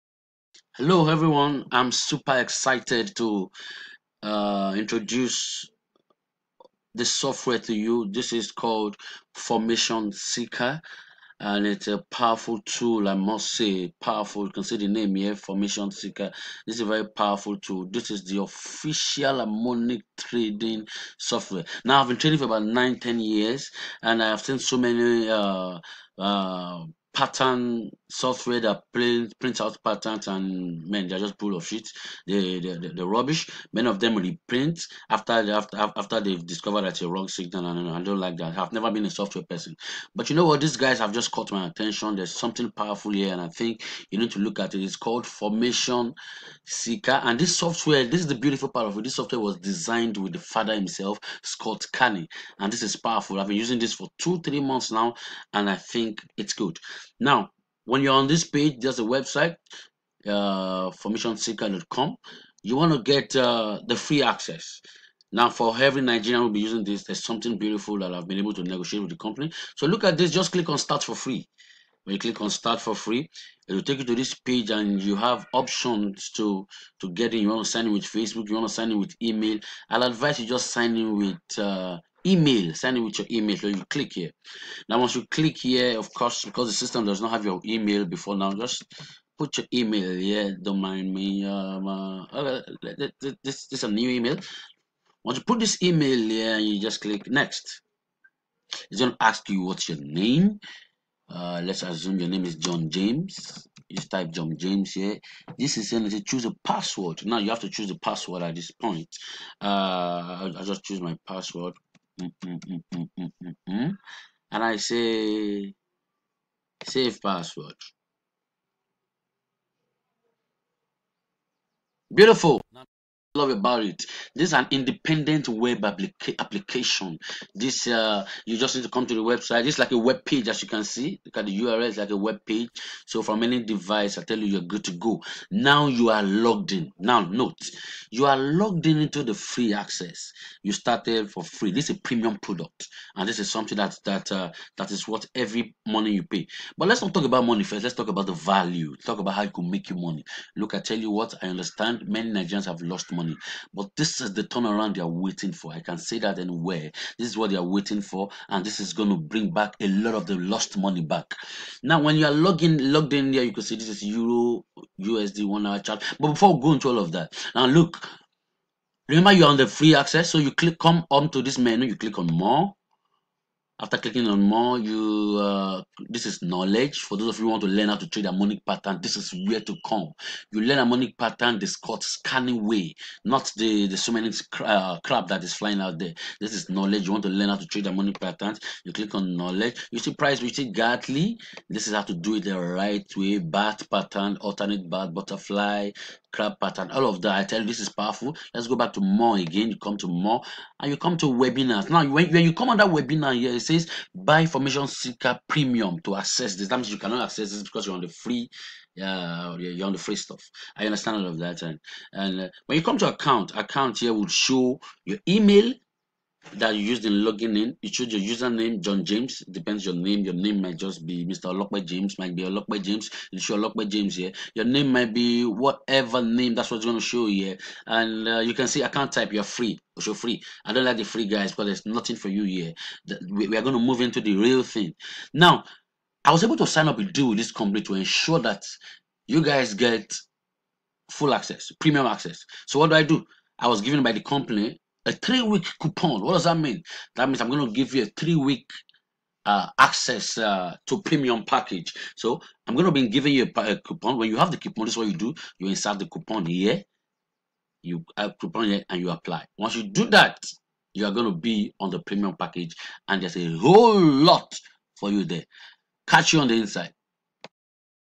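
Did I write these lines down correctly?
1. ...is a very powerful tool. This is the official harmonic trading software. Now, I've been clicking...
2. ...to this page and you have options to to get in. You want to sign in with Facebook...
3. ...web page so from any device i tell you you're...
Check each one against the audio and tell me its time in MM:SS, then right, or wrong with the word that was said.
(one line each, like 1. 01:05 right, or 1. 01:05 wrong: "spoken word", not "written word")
1. 00:16 wrong: "trading", not "clicking"
2. 01:14 right
3. 02:12 right.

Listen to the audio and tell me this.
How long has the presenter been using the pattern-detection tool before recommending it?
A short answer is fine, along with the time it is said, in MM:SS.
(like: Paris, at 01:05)
2-3 months, at 00:54.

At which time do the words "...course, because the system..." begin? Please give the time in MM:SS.
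01:26.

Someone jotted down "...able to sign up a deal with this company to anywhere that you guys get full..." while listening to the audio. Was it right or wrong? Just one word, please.
wrong.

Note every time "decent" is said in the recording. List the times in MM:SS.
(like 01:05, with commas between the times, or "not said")
not said.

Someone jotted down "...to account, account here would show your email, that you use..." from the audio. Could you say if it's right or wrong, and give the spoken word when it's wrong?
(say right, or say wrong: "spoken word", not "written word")
right.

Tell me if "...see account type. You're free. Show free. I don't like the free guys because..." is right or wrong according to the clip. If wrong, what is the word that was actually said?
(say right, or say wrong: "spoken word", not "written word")
right.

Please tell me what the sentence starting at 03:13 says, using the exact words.
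Bat pattern, alternate bat, butterfly, crab pattern, all of that.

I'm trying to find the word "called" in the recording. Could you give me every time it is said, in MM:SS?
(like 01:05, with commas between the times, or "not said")
00:08, 00:44.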